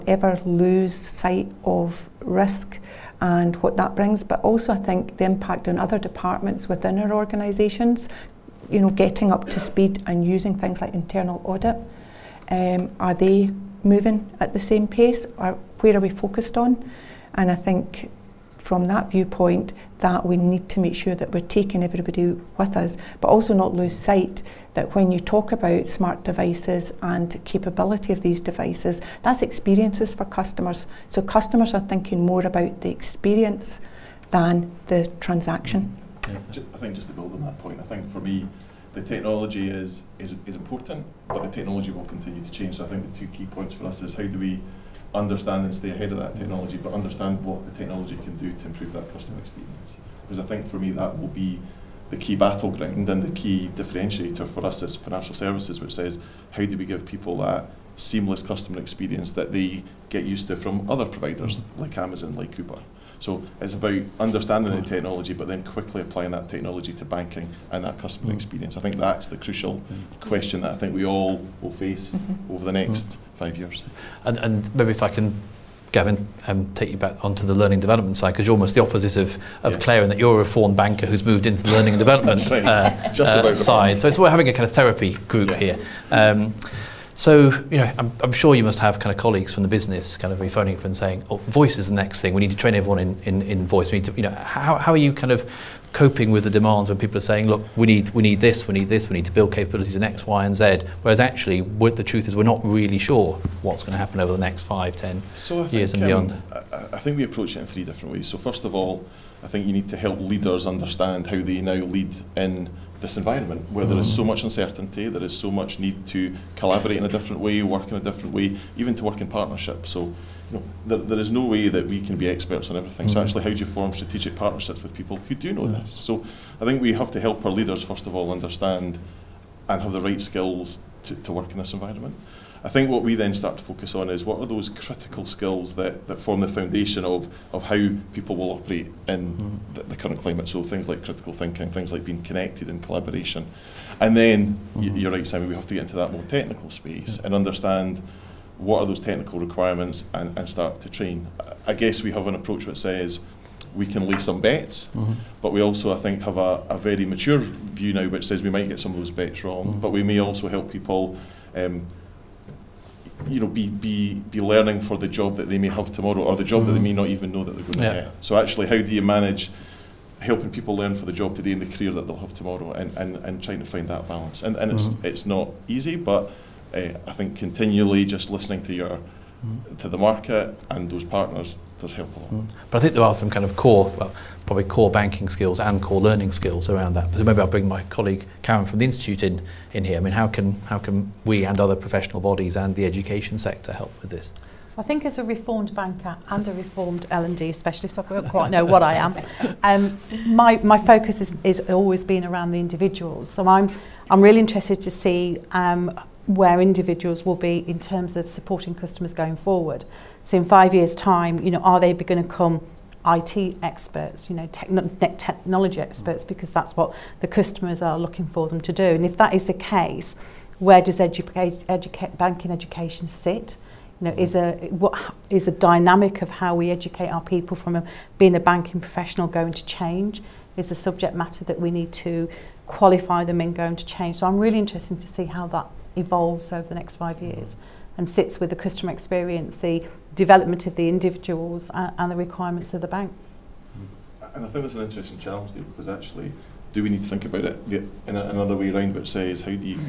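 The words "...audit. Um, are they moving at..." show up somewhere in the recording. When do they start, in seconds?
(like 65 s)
11 s.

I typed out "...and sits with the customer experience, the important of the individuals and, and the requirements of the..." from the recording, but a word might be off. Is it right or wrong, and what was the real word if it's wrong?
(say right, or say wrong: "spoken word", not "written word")
wrong: "development", not "important".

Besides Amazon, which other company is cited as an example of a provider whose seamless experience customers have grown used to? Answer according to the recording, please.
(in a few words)
Uber.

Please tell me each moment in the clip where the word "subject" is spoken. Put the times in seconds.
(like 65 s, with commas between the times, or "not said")
230 s.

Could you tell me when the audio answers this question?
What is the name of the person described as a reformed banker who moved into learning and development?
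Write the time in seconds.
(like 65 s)
75 s.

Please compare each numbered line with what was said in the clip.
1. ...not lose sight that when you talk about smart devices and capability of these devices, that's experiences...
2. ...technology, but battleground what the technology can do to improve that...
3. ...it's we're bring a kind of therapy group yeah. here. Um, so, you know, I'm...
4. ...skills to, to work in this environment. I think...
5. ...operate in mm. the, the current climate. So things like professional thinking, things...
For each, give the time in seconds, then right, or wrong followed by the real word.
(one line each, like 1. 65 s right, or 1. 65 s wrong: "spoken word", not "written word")
1. 23 s right
2. 46 s wrong: "understand", not "battleground"
3. 84 s wrong: "having", not "bring"
4. 130 s right
5. 138 s wrong: "critical", not "professional".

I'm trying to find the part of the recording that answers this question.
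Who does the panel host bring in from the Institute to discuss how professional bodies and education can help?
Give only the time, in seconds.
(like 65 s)
188 s.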